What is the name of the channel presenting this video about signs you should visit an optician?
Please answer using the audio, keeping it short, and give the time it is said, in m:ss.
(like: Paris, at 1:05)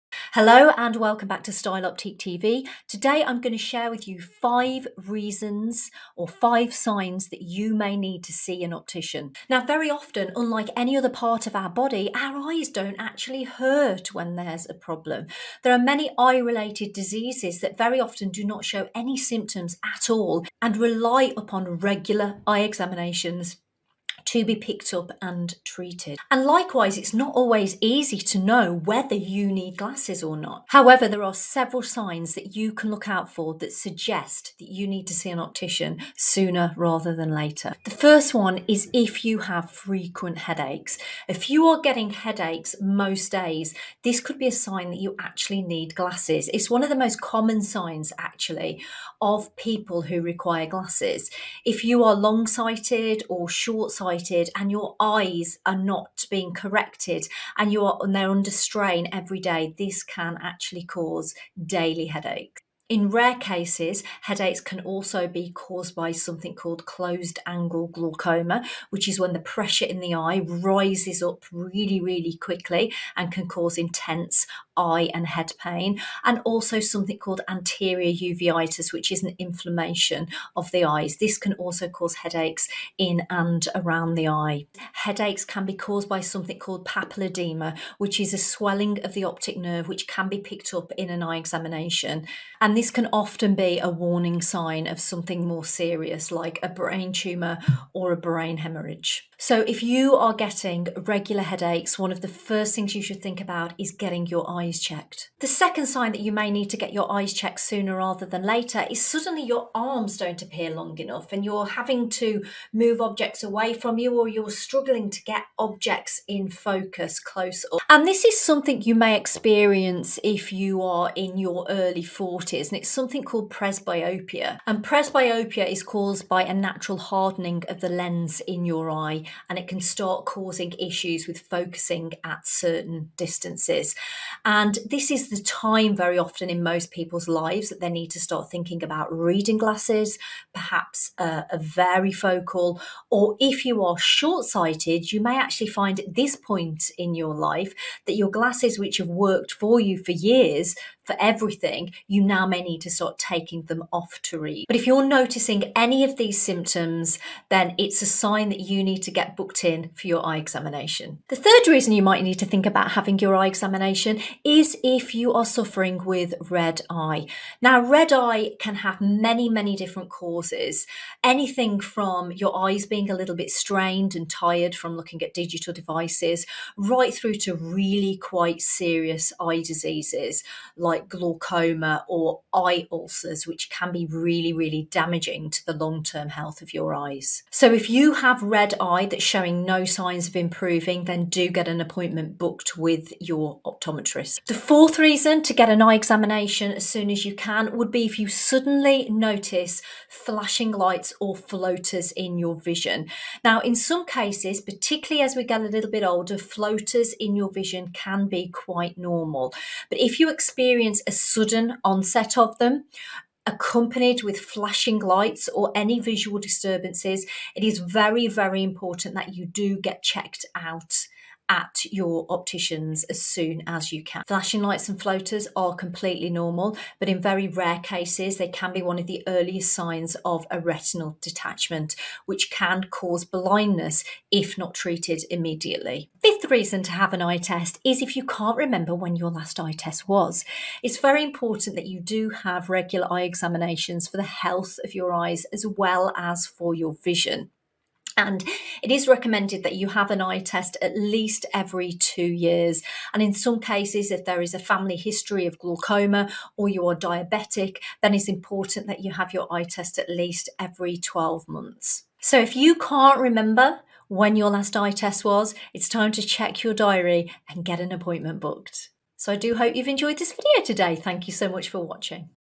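Style Optique TV, at 0:01.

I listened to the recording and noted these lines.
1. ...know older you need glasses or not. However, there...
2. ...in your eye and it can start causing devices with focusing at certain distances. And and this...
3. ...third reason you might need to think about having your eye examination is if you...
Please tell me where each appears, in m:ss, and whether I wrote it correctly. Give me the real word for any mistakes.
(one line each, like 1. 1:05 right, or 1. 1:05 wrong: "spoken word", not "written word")
1. 0:28 wrong: "whether", not "older"
2. 2:08 wrong: "issues", not "devices"
3. 2:41 right.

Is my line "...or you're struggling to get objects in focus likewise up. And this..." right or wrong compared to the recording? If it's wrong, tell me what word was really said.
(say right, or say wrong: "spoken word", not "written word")
wrong: "close", not "likewise".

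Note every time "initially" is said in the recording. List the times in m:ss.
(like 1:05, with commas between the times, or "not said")
not said.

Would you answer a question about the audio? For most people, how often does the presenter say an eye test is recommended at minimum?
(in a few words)
Every 2 years.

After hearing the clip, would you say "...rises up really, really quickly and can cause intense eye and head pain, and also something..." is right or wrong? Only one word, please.
right.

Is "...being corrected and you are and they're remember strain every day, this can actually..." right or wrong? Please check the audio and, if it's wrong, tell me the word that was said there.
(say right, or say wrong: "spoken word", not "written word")
wrong: "under", not "remember".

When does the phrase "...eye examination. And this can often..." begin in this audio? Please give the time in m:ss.
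1:31.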